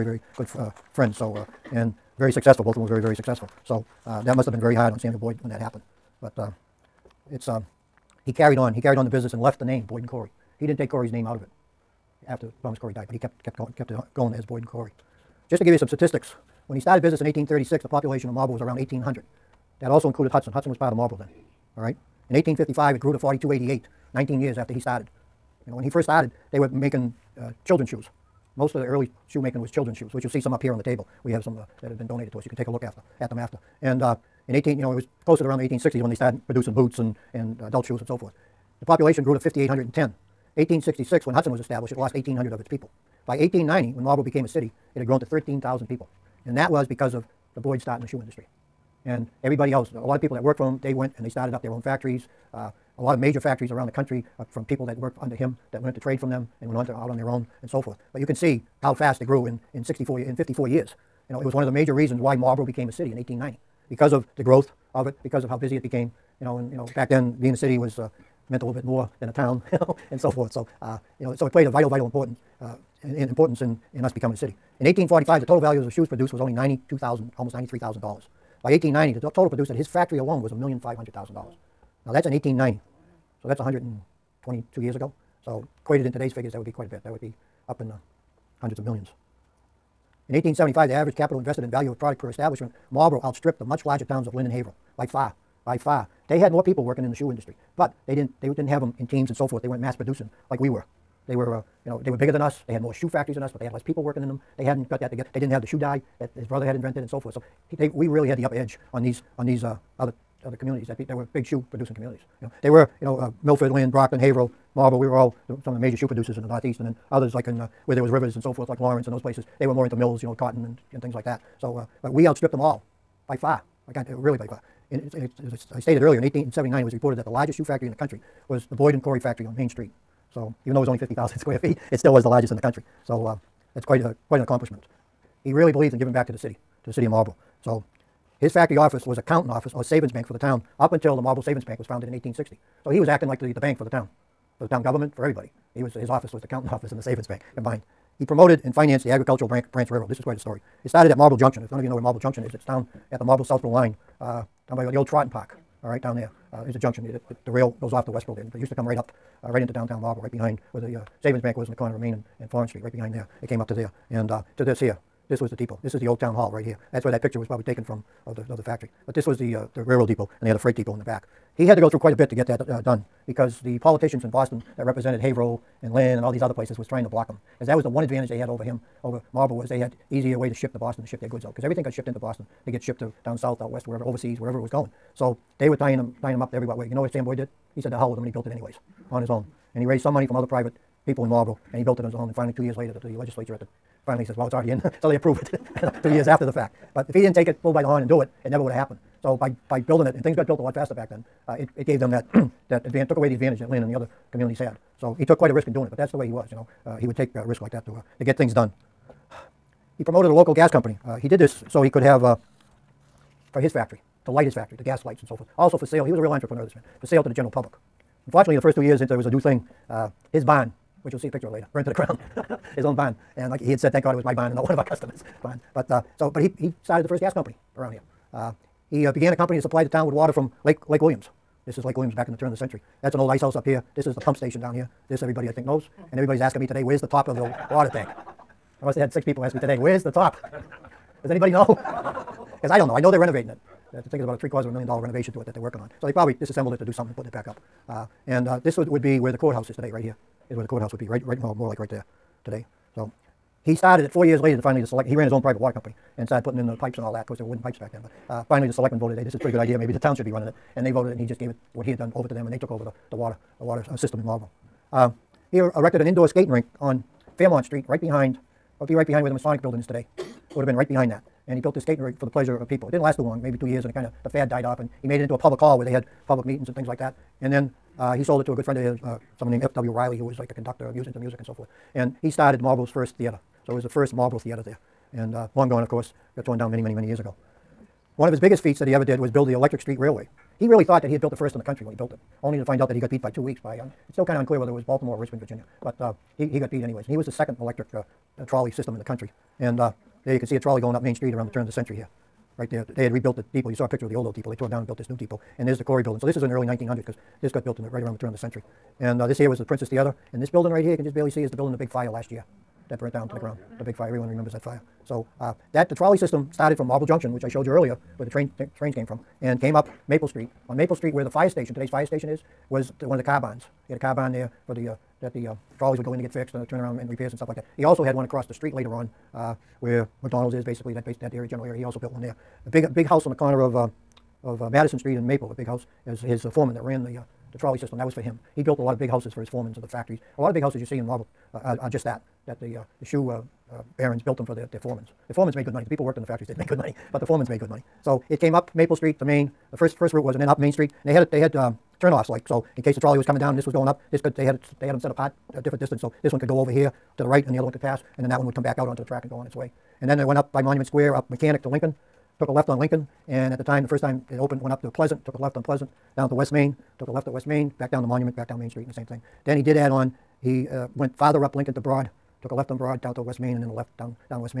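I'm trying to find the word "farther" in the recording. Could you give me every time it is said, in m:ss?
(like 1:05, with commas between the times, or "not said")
6:11.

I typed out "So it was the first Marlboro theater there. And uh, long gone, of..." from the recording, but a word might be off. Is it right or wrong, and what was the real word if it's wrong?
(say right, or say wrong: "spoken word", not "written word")
right.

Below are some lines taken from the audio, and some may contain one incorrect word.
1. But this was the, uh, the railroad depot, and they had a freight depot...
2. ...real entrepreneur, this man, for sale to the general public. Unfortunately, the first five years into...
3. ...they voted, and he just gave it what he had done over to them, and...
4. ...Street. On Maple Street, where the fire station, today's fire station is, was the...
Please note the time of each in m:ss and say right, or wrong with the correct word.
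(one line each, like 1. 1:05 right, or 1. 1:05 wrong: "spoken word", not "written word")
1. 2:49 right
2. 3:36 wrong: "two", not "five"
3. 4:20 right
4. 5:20 right.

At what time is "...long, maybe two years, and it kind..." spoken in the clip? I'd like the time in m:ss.
4:33.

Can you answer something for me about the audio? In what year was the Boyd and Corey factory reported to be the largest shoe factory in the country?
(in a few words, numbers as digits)
1879.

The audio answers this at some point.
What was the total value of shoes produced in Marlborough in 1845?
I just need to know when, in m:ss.
1:16.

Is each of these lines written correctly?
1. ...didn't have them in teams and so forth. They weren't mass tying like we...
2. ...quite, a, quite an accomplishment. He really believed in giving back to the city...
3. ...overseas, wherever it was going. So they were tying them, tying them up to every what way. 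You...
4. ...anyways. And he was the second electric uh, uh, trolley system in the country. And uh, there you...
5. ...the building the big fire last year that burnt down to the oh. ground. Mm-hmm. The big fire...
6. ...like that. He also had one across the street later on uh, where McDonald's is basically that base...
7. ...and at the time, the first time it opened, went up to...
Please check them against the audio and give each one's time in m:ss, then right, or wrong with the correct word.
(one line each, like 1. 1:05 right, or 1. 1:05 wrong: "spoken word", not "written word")
1. 1:38 wrong: "producing", not "tying"
2. 2:13 right
3. 3:04 right
4. 4:56 right
5. 5:11 right
6. 5:27 right
7. 6:03 right.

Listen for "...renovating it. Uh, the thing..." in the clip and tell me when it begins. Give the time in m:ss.
4:03.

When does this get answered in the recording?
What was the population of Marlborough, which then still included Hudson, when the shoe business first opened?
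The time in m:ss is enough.
0:18.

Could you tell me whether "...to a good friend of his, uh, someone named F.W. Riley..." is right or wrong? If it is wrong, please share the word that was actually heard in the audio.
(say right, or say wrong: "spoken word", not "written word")
right.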